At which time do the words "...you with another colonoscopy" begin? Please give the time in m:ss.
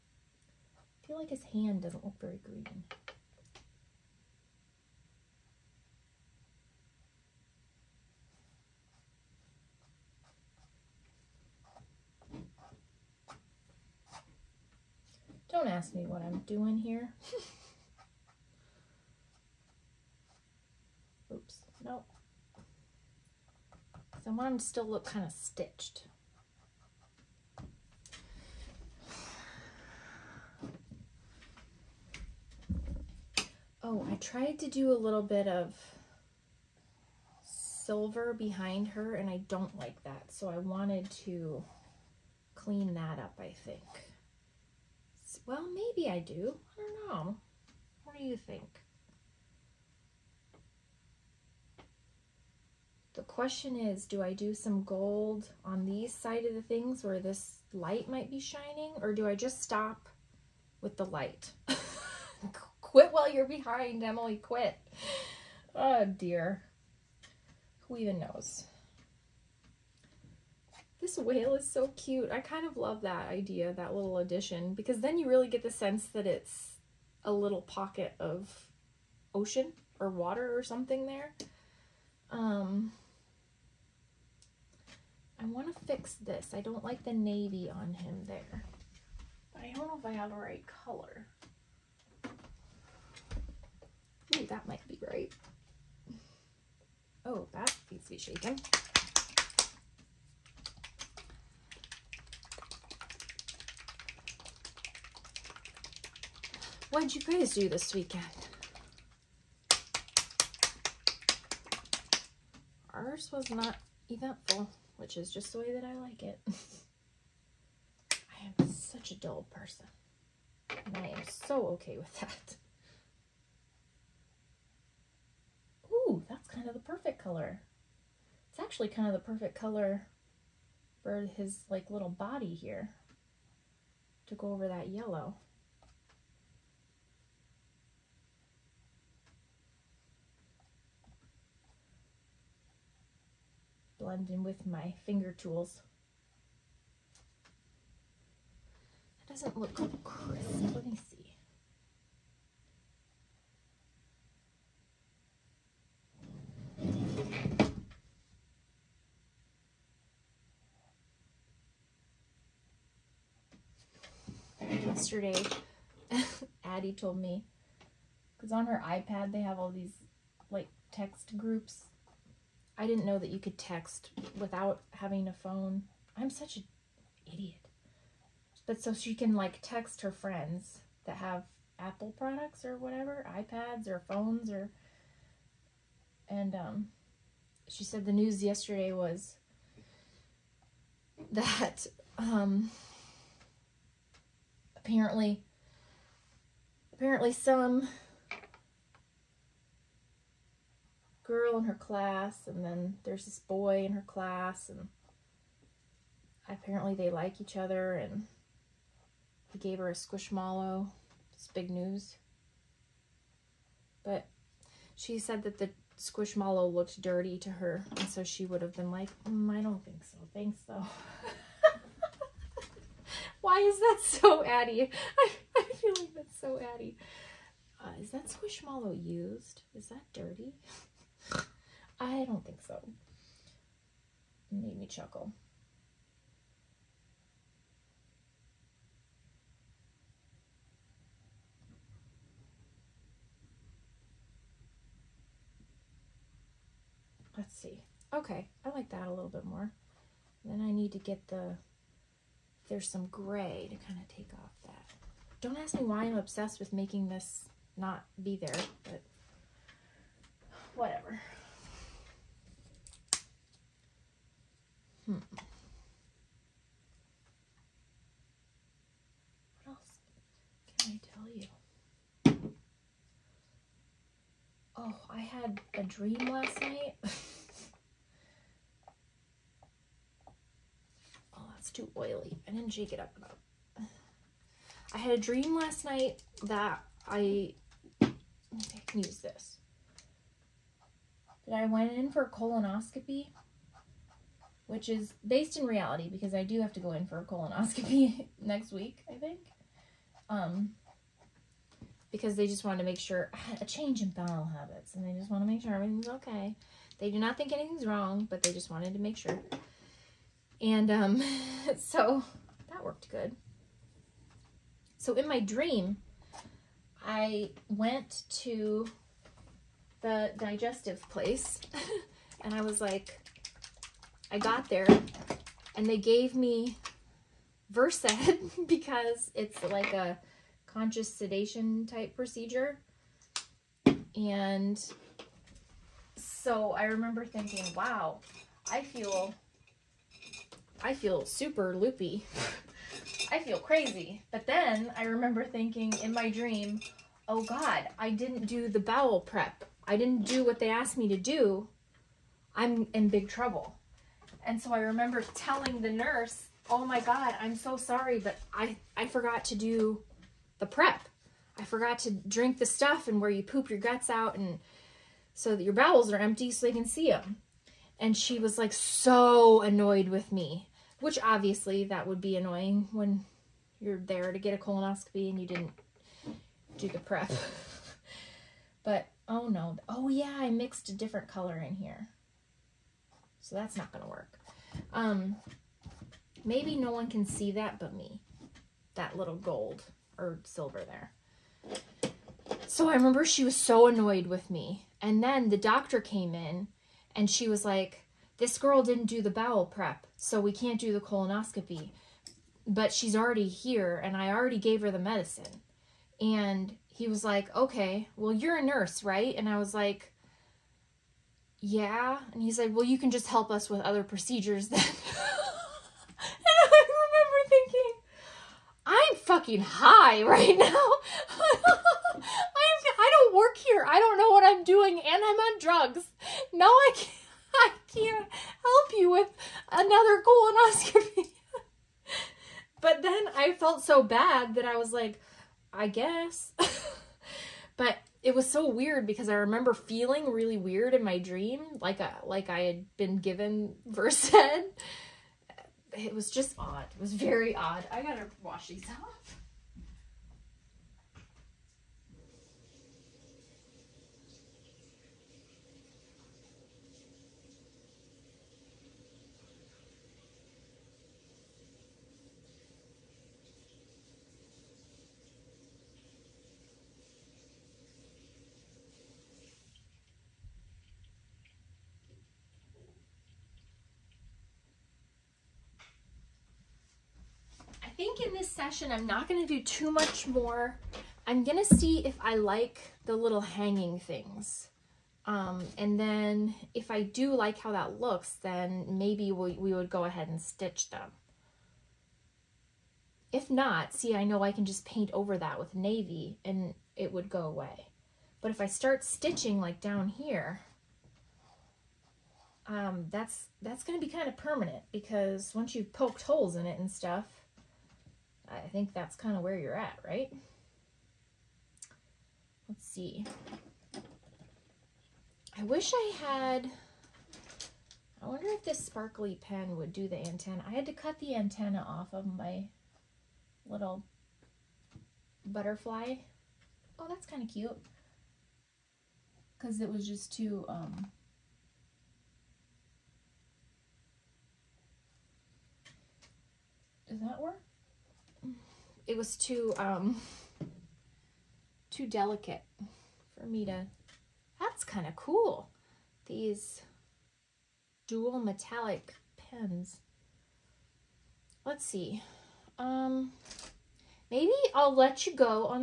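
7:08.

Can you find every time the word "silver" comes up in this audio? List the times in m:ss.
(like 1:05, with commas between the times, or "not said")
0:37, 6:30.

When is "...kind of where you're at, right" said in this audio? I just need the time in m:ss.
8:29.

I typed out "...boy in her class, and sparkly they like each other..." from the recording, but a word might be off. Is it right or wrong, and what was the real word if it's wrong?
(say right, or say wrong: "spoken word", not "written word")
wrong: "apparently", not "sparkly".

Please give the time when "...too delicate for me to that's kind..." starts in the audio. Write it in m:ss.
9:01.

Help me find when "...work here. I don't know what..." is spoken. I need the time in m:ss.
7:03.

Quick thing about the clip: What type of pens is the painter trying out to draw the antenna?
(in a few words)
dual metallic pens.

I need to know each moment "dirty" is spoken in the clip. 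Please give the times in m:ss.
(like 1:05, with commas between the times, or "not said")
3:37, 3:50.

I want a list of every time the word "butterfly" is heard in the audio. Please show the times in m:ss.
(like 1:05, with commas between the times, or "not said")
8:45.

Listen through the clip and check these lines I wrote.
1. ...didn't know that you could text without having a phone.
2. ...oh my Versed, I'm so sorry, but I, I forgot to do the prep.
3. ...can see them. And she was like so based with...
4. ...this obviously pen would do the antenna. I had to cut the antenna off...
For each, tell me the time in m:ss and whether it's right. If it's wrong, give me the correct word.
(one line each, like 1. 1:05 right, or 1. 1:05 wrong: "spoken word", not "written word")
1. 2:52 right
2. 5:56 wrong: "God", not "Versed"
3. 6:06 wrong: "annoyed", not "based"
4. 8:38 wrong: "sparkly", not "obviously".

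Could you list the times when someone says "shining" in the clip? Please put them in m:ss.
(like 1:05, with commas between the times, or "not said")
0:58.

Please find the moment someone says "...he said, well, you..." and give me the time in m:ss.
6:52.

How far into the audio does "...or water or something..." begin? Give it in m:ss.
1:19.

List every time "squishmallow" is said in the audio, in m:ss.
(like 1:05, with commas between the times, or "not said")
3:29, 3:35, 3:48.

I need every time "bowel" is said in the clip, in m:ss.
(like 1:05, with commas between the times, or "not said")
5:04, 5:48, 6:05, 6:39.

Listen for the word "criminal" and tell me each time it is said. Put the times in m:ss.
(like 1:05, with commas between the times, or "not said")
not said.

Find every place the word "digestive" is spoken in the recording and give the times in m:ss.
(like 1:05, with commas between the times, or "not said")
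5:20.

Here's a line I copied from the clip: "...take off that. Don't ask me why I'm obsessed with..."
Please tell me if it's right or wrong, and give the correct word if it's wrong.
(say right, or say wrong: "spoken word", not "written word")
right.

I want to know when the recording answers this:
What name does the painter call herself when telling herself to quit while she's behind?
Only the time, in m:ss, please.
1:04.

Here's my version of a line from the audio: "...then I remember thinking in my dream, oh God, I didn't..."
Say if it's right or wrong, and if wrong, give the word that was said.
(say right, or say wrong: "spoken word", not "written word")
right.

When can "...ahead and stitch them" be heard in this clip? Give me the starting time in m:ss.
8:10.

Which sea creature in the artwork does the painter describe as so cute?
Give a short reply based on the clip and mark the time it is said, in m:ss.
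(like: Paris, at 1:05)
whale, at 1:11.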